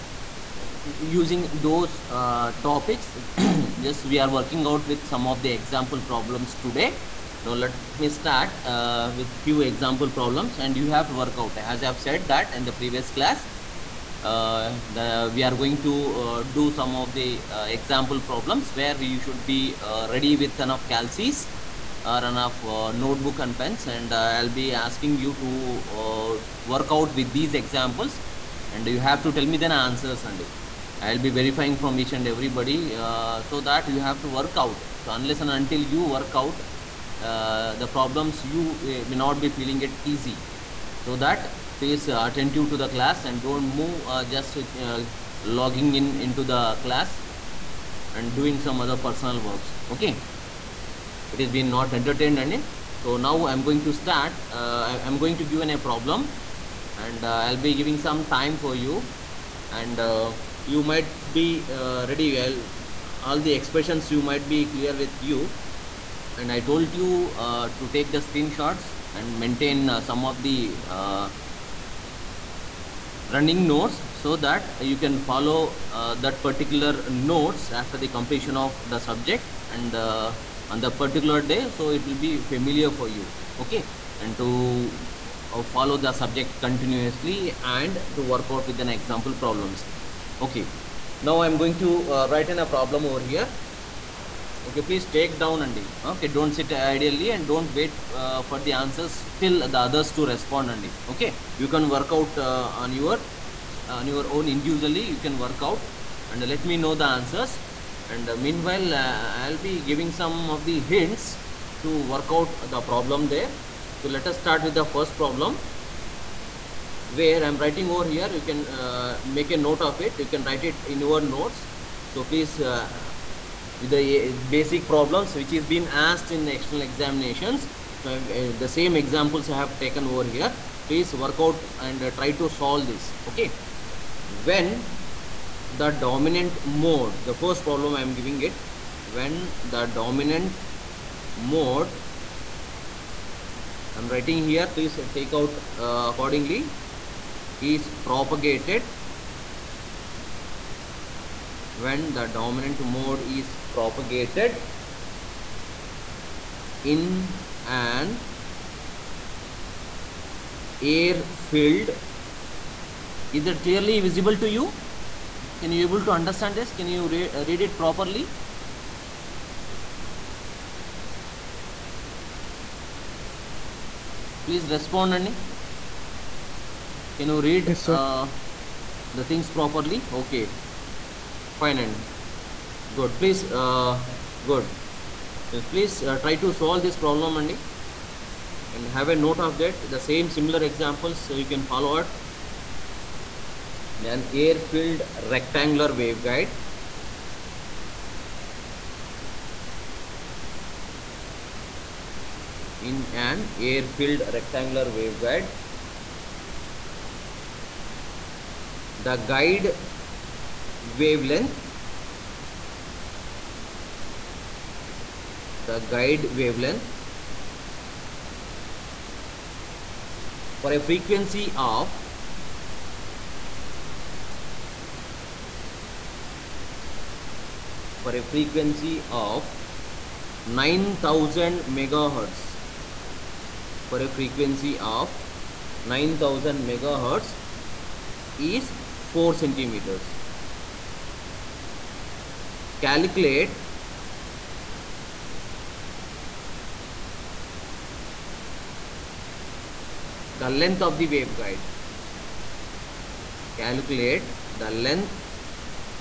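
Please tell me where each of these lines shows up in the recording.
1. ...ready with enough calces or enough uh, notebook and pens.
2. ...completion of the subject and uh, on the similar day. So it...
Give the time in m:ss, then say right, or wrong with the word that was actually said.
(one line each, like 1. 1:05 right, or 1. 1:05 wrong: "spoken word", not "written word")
1. 0:20 right
2. 1:18 wrong: "particular", not "similar".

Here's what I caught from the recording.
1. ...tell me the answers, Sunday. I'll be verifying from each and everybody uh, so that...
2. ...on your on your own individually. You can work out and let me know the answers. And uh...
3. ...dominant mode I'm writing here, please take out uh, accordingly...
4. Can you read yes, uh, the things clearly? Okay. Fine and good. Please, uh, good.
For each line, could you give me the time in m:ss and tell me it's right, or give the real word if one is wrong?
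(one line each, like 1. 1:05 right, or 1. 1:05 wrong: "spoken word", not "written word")
1. 0:29 right
2. 1:42 right
3. 2:19 right
4. 2:57 wrong: "properly", not "clearly".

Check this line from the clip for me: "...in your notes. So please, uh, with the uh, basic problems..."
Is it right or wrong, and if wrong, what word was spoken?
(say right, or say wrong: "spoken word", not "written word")
right.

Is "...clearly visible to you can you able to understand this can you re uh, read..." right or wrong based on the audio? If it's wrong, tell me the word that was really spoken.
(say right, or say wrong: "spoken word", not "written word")
right.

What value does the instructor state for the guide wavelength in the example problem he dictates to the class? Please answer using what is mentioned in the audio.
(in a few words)
4 centimeters.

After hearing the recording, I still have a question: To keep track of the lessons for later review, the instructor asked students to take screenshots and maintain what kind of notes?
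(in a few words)
running notes.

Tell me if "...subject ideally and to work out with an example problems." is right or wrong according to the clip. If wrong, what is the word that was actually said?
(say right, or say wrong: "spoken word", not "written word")
wrong: "continuously", not "ideally".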